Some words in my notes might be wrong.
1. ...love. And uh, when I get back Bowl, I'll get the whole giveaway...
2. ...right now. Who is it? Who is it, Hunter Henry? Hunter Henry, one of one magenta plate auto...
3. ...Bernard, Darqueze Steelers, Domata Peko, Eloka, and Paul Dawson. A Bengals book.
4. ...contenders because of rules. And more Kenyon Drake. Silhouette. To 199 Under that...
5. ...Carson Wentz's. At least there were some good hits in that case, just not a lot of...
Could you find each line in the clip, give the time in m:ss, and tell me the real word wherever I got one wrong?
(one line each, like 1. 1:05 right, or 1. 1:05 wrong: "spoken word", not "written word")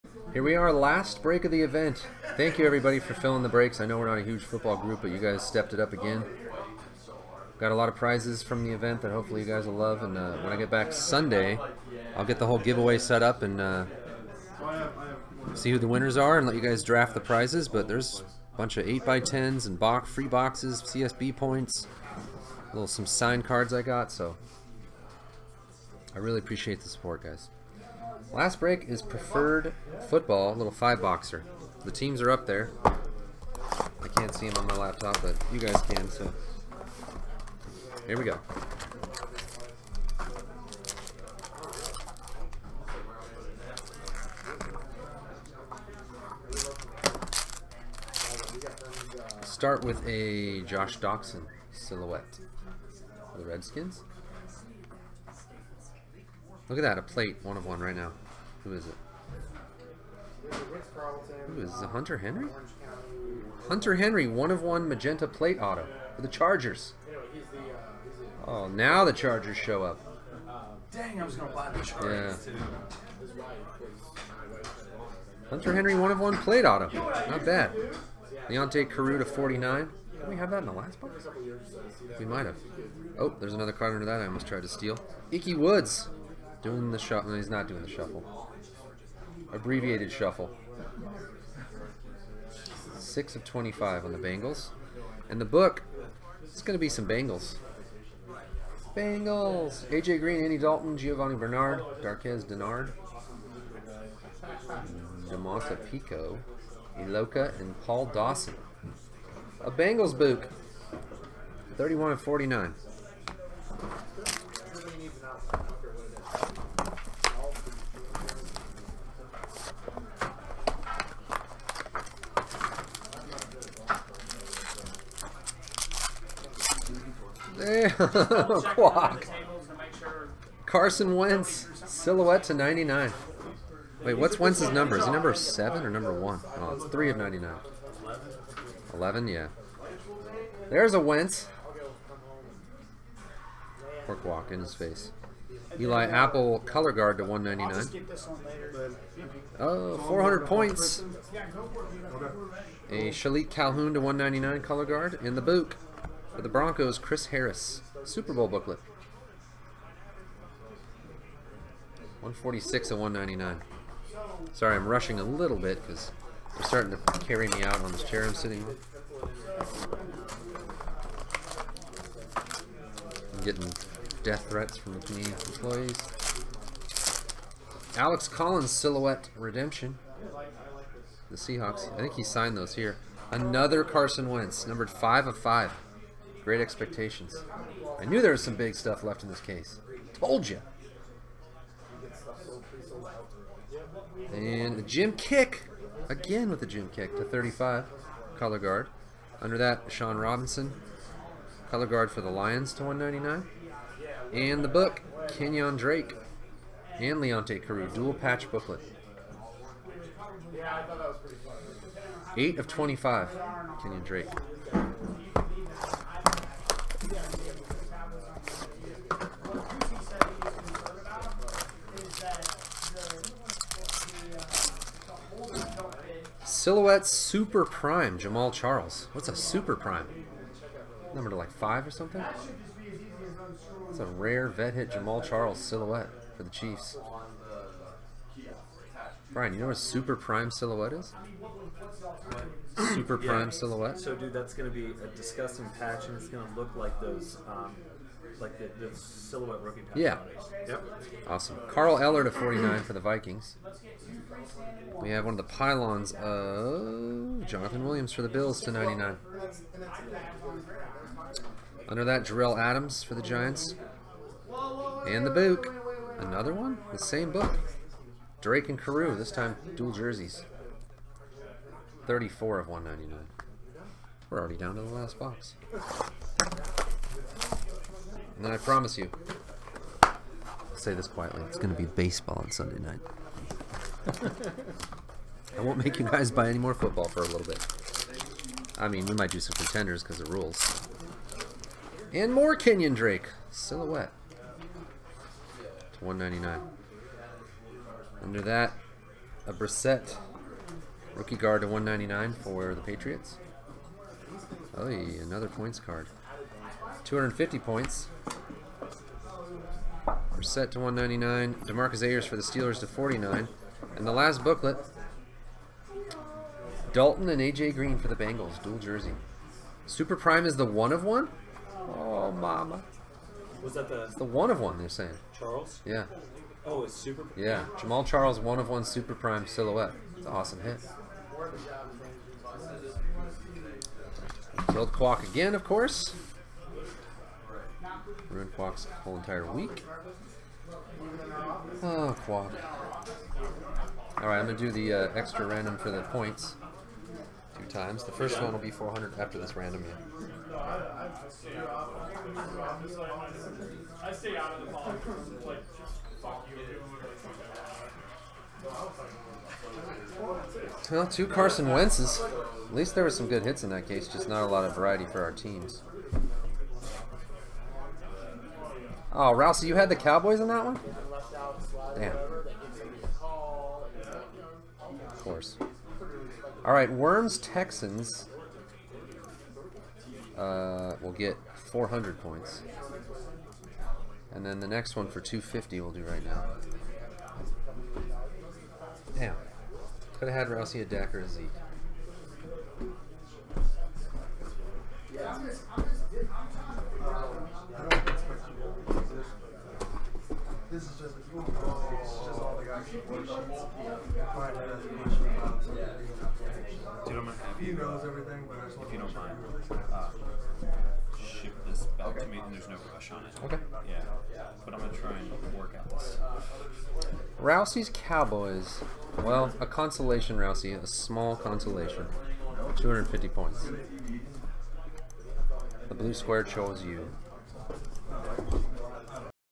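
1. 0:09 wrong: "Sunday", not "Bowl"
2. 0:57 right
3. 1:41 wrong: "Dennard", not "Steelers"
4. 4:49 right
5. 6:01 right.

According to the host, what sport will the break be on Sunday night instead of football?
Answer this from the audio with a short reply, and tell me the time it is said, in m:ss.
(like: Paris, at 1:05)
Baseball, at 4:41.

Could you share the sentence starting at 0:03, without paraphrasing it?
I know we're not a huge football group, but you guys stepped it up again.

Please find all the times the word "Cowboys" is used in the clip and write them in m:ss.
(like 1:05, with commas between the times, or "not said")
6:09, 6:57.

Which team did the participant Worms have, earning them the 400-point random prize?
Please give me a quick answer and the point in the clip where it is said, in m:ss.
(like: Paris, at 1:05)
Texans, at 6:16.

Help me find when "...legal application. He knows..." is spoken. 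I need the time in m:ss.
6:45.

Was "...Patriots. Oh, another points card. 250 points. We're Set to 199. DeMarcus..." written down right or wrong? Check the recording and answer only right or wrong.
right.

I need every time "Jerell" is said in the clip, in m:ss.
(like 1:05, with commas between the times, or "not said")
4:22.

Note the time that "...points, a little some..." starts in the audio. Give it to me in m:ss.
0:21.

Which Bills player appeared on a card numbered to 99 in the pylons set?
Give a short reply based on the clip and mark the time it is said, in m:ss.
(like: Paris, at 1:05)
Jonathan Williams, at 4:17.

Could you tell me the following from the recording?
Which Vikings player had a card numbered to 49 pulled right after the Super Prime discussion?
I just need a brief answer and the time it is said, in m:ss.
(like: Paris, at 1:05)
Carl Eller, at 4:11.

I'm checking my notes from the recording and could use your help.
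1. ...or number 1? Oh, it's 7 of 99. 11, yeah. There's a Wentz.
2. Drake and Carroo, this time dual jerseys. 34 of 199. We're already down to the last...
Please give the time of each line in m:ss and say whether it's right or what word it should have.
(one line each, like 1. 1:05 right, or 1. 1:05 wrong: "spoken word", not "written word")
1. 2:15 wrong: "3", not "7"
2. 4:28 right.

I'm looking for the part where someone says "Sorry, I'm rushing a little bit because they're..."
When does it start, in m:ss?
2:44.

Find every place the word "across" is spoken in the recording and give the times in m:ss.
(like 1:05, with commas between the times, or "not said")
not said.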